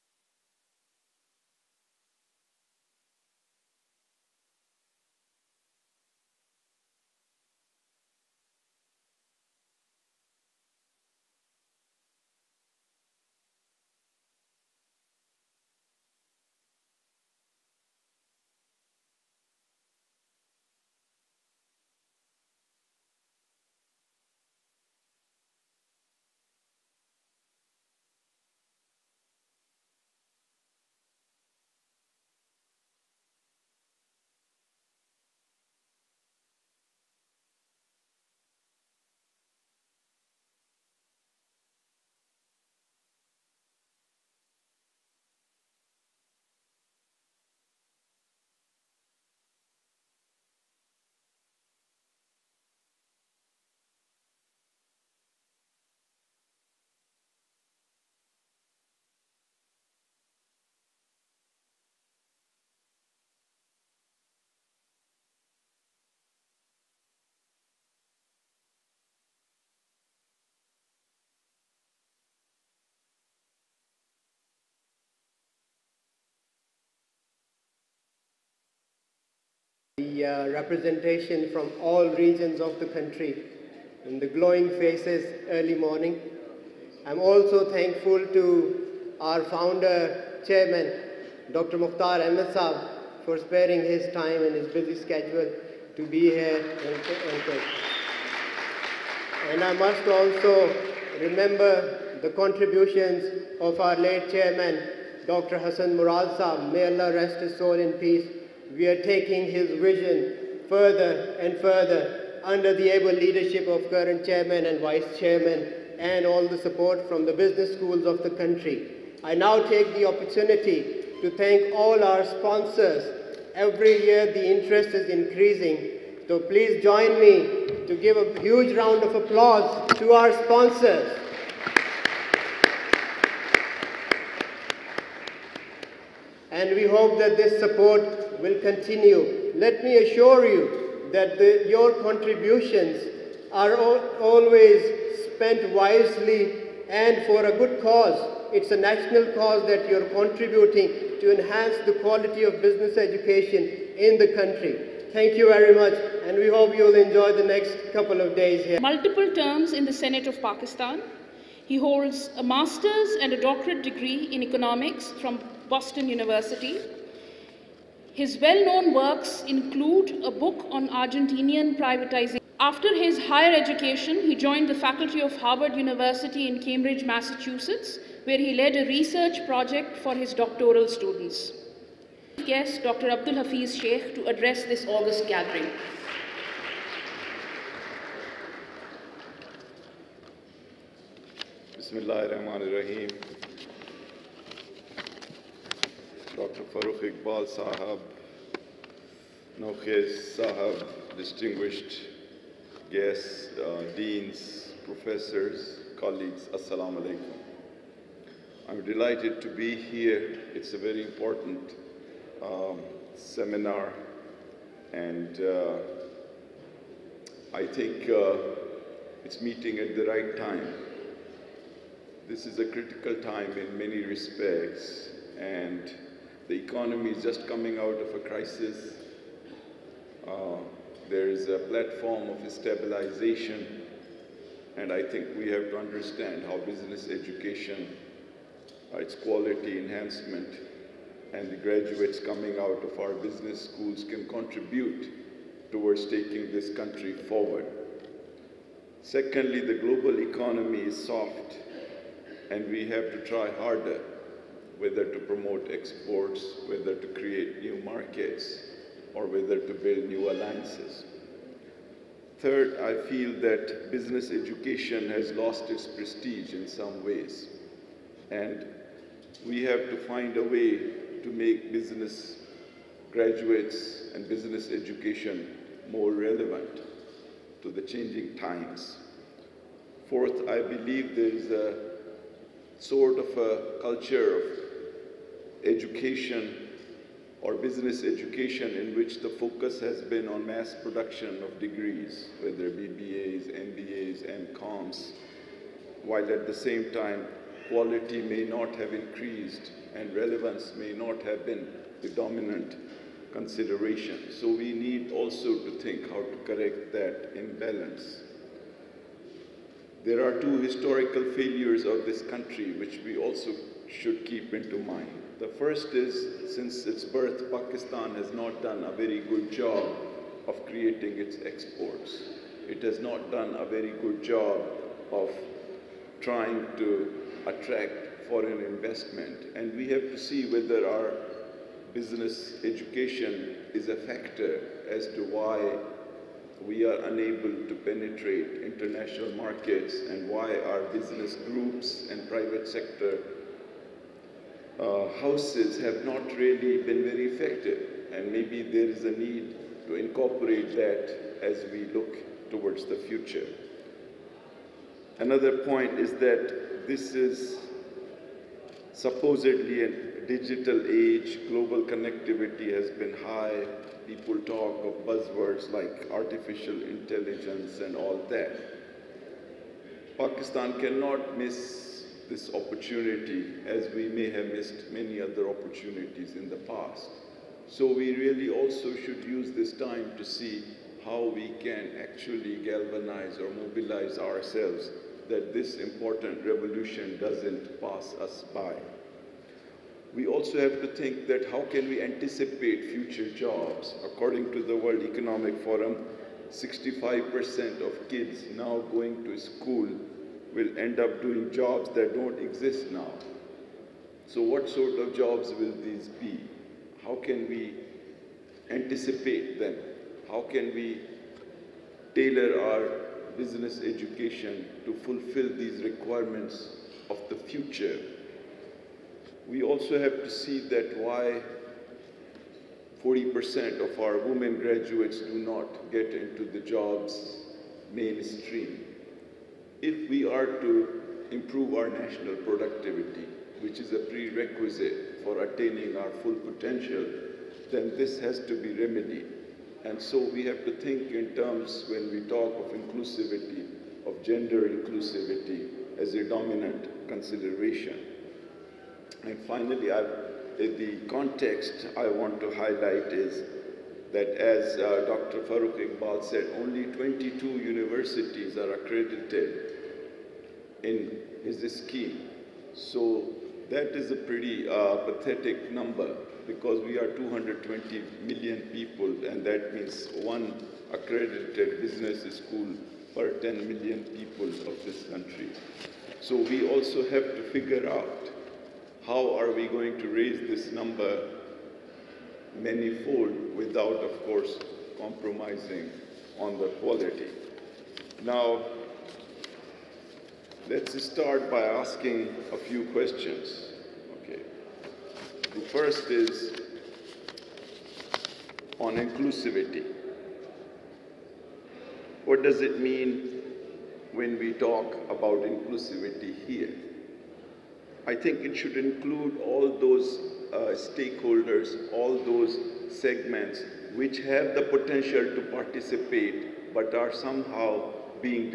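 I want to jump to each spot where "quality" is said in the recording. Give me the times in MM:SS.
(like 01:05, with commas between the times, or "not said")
02:32, 03:59, 04:57, 08:06.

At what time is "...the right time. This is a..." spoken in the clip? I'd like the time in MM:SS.
03:39.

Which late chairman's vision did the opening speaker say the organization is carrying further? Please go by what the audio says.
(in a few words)
Dr. Hassan Murad.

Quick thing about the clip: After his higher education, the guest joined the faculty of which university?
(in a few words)
Harvard University.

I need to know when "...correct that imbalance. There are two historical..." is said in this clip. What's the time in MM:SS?
05:06.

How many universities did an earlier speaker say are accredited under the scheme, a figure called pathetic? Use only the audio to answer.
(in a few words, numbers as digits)
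22.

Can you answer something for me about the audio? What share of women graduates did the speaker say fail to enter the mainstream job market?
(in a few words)
40%.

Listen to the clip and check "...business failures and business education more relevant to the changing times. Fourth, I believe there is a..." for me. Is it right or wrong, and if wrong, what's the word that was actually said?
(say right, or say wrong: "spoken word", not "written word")
wrong: "graduates", not "failures".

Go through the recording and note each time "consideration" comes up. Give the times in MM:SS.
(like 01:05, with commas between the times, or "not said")
05:03, 07:27.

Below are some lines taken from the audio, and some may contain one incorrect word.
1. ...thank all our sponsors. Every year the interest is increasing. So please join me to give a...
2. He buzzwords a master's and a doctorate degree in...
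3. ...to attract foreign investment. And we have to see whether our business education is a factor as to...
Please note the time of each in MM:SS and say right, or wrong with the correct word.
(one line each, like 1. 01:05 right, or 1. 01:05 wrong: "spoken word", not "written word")
1. 02:01 right
2. 02:41 wrong: "holds", not "buzzwords"
3. 05:26 right.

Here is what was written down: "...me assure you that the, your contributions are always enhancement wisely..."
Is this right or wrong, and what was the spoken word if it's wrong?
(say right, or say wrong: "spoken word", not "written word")
wrong: "spent", not "enhancement".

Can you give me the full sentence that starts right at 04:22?
Third, I feel that business education has lost its prestige in some ways.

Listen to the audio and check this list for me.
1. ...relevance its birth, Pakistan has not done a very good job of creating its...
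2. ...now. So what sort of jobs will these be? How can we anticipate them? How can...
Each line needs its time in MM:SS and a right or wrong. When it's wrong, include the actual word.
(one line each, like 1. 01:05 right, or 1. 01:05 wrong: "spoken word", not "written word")
1. 05:16 wrong: "since", not "relevance"
2. 06:42 right.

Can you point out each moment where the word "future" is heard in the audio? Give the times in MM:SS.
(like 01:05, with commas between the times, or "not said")
05:53, 06:32, 06:57.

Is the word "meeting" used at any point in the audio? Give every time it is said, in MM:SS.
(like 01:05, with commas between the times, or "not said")
03:39.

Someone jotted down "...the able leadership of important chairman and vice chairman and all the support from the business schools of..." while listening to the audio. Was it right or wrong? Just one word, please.
wrong.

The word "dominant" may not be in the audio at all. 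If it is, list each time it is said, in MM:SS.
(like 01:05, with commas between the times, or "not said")
05:02, 07:26.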